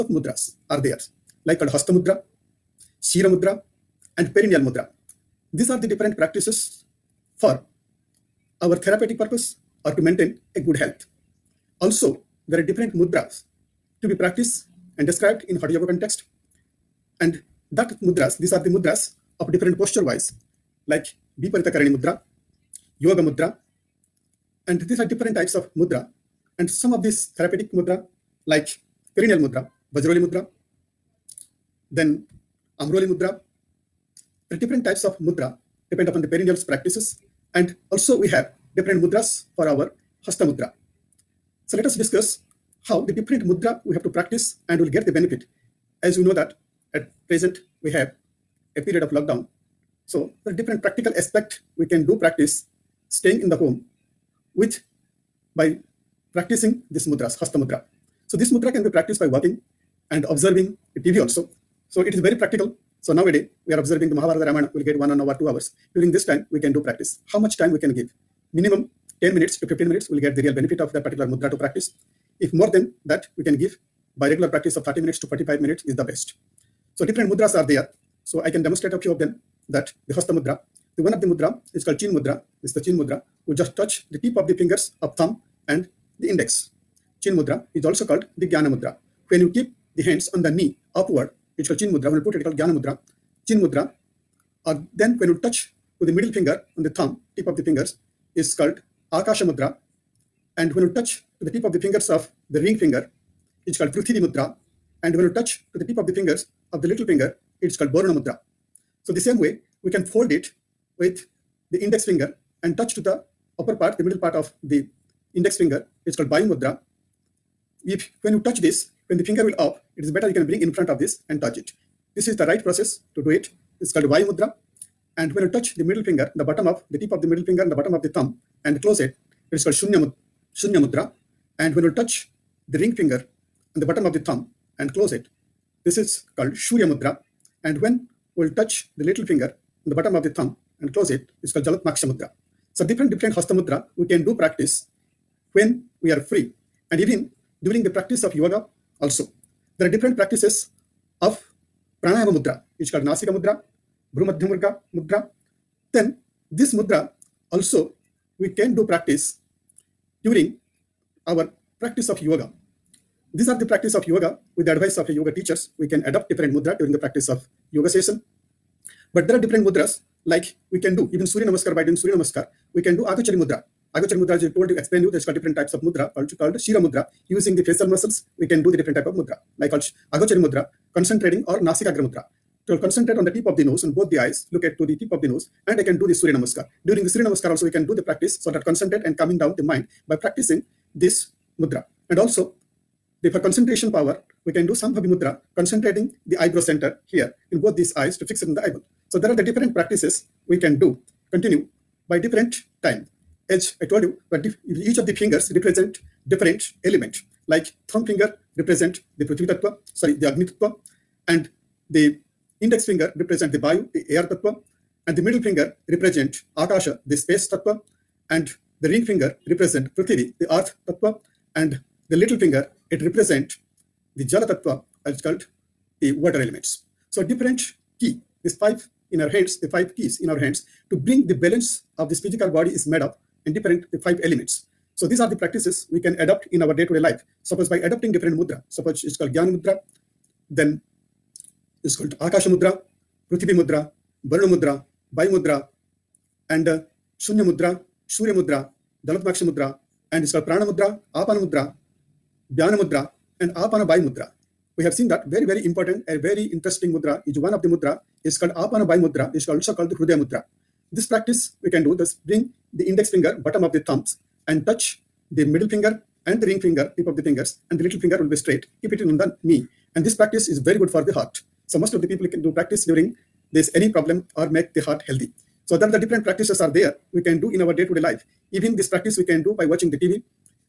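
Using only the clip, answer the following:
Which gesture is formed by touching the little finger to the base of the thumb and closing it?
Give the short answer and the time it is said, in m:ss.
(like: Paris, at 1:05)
Jalatmaksha Mudra, at 2:21.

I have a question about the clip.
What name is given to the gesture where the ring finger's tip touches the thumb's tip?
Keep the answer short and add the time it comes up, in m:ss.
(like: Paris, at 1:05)
Prithivi Mudra, at 1:43.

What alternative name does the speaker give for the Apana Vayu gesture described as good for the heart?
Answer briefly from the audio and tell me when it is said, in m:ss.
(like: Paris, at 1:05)
Hrudaya Mudra, at 4:19.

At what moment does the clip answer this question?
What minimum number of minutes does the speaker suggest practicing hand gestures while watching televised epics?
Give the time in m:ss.
1:08.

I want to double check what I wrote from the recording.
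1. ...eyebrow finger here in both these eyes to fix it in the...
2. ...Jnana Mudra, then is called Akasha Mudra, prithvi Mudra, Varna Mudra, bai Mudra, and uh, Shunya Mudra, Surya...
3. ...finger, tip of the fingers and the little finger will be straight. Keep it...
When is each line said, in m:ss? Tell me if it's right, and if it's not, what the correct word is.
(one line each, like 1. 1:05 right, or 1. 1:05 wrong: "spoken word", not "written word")
1. 3:16 wrong: "center", not "finger"
2. 3:59 right
3. 4:26 right.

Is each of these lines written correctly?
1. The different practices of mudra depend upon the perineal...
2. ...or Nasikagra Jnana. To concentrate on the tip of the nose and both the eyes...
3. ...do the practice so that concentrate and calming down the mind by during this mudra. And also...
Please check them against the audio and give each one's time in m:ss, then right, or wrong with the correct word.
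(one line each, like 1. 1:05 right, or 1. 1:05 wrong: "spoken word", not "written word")
1. 0:34 wrong: "types", not "practices"
2. 3:01 wrong: "Mudra", not "Jnana"
3. 3:07 wrong: "practicing", not "during".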